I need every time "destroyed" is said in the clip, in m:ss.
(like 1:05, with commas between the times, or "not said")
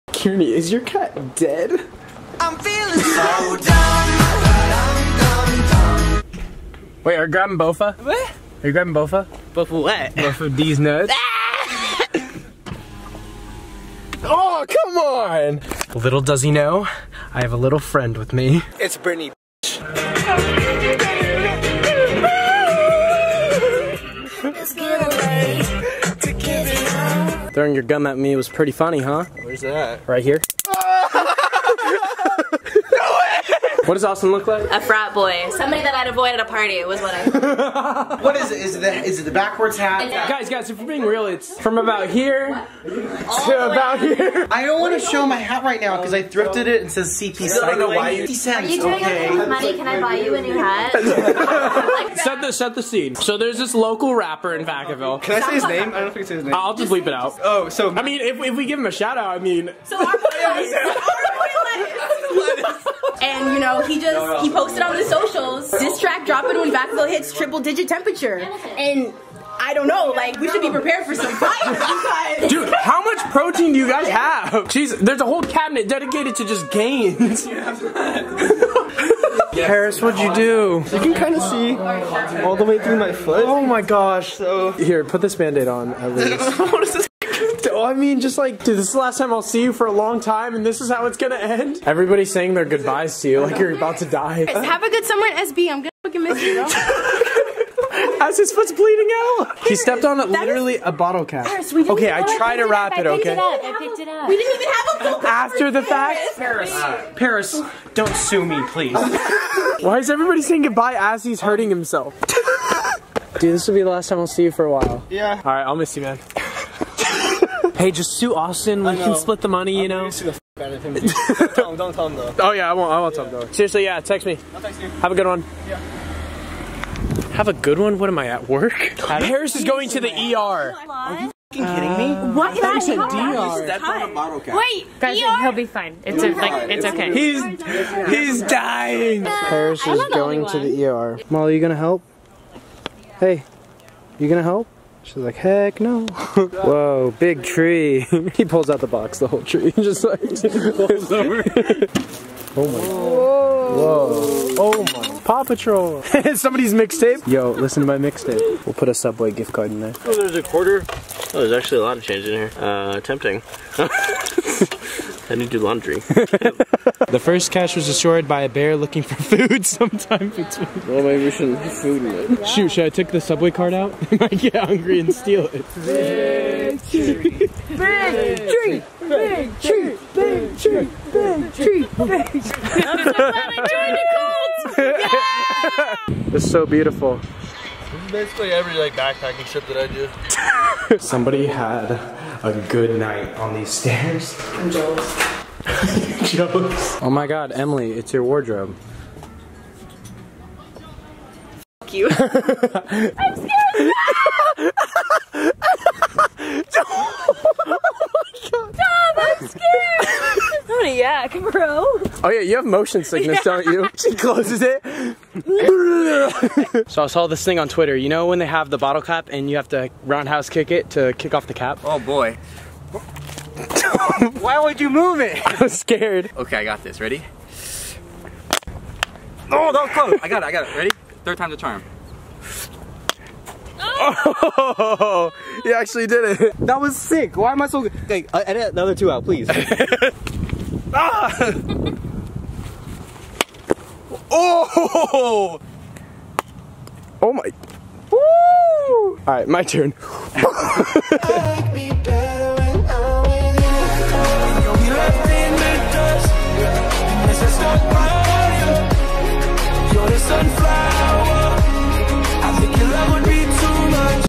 2:47.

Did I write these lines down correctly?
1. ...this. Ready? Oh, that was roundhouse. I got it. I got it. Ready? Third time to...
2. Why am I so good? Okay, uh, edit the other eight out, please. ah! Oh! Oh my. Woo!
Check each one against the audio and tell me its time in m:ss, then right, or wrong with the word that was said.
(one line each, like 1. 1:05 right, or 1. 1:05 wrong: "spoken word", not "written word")
1. 3:46 wrong: "close", not "roundhouse"
2. 3:57 wrong: "two", not "eight".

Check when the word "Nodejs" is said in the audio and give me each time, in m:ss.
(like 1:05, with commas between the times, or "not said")
not said.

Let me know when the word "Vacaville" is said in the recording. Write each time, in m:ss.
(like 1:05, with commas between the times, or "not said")
0:54, 1:06.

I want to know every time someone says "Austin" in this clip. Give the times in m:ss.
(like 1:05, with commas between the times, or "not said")
0:34, 1:58.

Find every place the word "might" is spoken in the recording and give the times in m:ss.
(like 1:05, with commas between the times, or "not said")
2:54.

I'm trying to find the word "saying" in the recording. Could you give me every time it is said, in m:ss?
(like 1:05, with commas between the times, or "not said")
1:32, 1:50.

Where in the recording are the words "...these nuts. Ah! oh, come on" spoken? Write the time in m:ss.
0:10.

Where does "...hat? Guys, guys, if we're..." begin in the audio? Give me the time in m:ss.
0:39.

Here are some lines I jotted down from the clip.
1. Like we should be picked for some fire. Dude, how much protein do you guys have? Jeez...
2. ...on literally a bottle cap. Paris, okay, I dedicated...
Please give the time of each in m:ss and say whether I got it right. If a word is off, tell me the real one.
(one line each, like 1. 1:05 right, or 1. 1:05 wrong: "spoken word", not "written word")
1. 1:10 wrong: "prepared", not "picked"
2. 1:40 wrong: "tried", not "dedicated".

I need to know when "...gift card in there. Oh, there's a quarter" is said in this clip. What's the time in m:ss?
2:39.